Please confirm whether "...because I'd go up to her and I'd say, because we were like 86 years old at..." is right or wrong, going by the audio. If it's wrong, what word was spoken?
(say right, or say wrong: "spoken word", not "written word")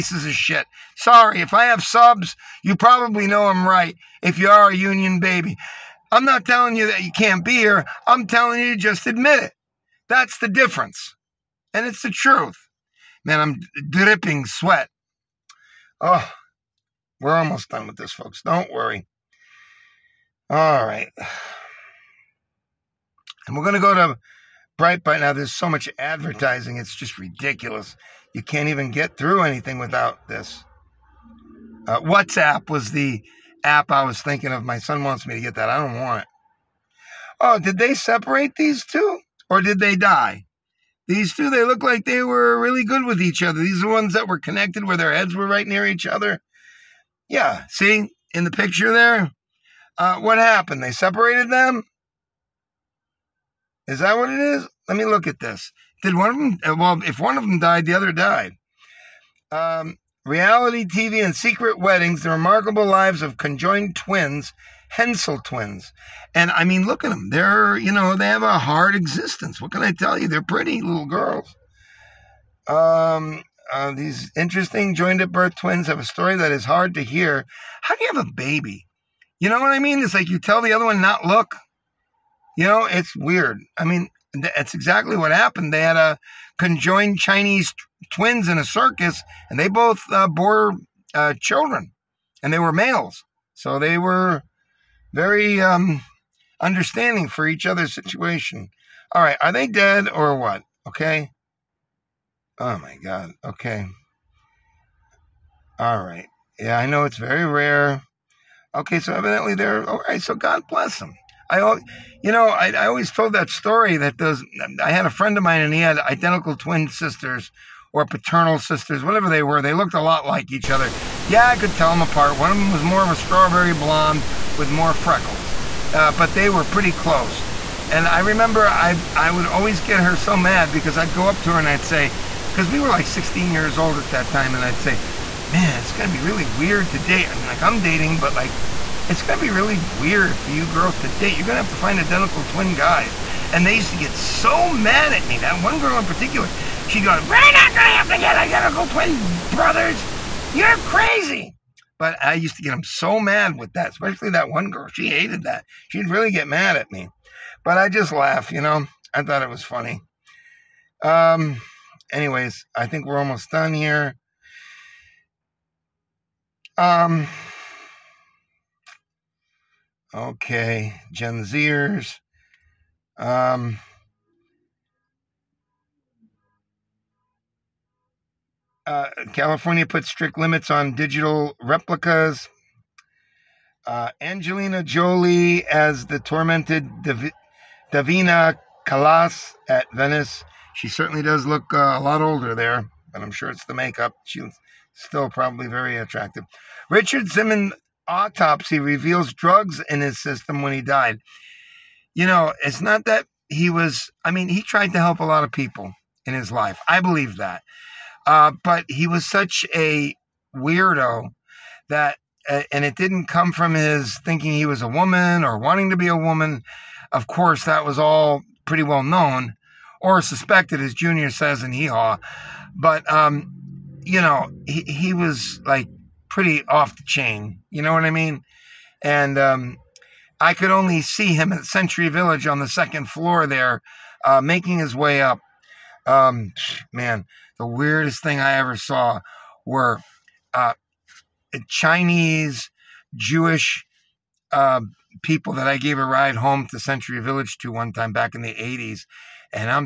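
wrong: "16", not "86".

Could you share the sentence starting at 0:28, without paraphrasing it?
You can't even get through anything without this.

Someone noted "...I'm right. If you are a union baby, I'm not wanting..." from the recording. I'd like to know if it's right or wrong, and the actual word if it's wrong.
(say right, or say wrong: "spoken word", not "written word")
wrong: "telling", not "wanting".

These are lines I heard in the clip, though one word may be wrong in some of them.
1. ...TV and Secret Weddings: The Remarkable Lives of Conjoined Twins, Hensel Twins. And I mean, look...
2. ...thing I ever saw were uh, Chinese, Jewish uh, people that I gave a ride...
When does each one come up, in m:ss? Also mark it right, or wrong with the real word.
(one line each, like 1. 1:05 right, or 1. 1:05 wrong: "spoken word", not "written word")
1. 1:00 right
2. 3:58 right.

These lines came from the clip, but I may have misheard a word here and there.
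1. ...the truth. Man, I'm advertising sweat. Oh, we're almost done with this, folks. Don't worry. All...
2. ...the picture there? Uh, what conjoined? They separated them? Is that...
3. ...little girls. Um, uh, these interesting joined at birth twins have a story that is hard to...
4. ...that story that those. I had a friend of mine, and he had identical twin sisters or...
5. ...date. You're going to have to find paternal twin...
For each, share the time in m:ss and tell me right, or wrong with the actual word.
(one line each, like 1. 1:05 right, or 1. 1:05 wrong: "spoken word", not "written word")
1. 0:12 wrong: "dripping", not "advertising"
2. 0:48 wrong: "happened", not "conjoined"
3. 1:10 right
4. 1:53 right
5. 2:21 wrong: "identical", not "paternal".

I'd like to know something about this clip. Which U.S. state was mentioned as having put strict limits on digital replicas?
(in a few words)
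California.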